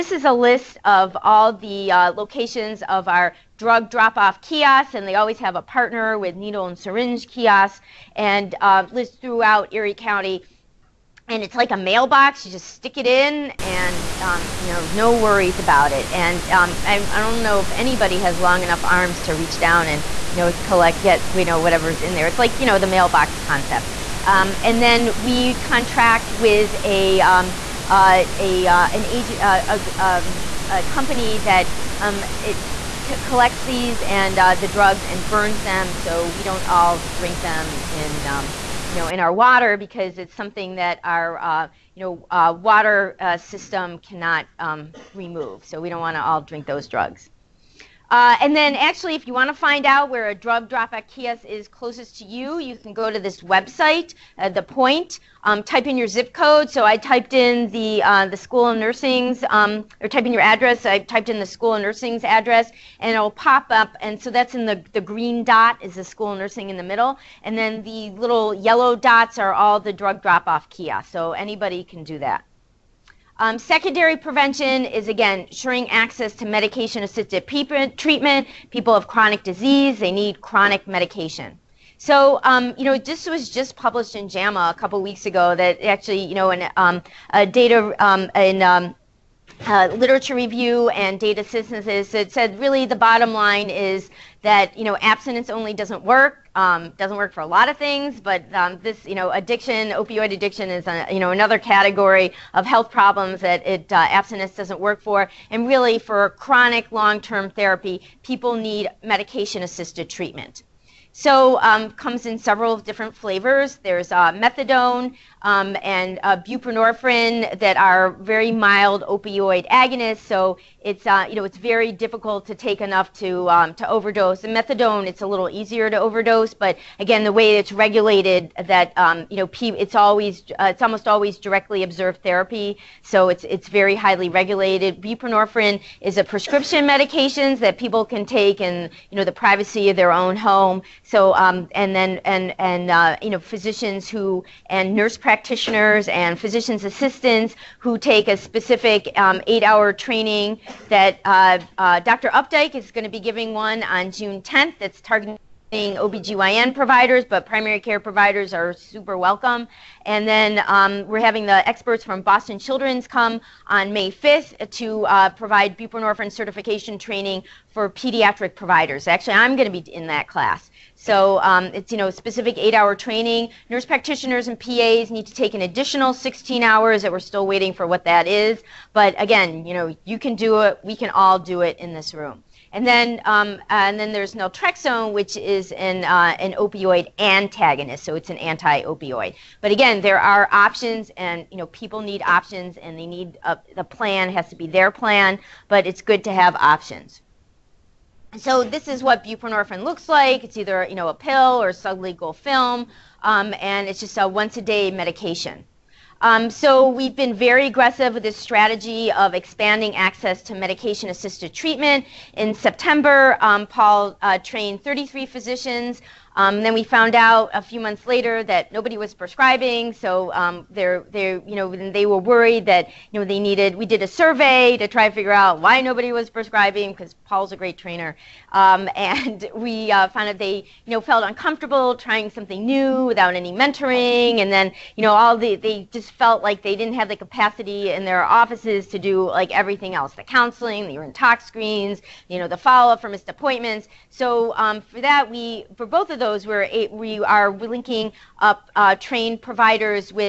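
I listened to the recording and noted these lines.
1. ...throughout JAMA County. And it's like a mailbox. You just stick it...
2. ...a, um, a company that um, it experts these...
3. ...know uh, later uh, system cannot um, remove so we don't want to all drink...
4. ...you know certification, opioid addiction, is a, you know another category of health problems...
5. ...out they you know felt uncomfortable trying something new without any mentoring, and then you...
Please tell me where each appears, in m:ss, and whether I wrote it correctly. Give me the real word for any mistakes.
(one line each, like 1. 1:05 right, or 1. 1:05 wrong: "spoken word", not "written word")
1. 0:09 wrong: "Erie", not "JAMA"
2. 0:29 wrong: "collects", not "experts"
3. 0:42 wrong: "water", not "later"
4. 1:39 wrong: "addiction", not "certification"
5. 3:50 right.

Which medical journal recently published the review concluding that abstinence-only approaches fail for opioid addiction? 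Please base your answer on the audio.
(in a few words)
JAMA.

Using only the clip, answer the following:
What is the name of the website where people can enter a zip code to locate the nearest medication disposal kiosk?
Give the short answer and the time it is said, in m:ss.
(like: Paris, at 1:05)
The Point, at 0:54.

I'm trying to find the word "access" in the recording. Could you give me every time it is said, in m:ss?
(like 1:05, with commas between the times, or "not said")
1:15, 3:29.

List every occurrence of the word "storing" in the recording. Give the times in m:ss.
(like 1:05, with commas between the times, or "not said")
not said.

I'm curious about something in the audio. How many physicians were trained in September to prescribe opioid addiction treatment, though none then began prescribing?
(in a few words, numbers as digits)
33.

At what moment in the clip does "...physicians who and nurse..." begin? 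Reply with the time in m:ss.
2:23.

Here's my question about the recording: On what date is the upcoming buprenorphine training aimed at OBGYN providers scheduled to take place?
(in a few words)
June 10th.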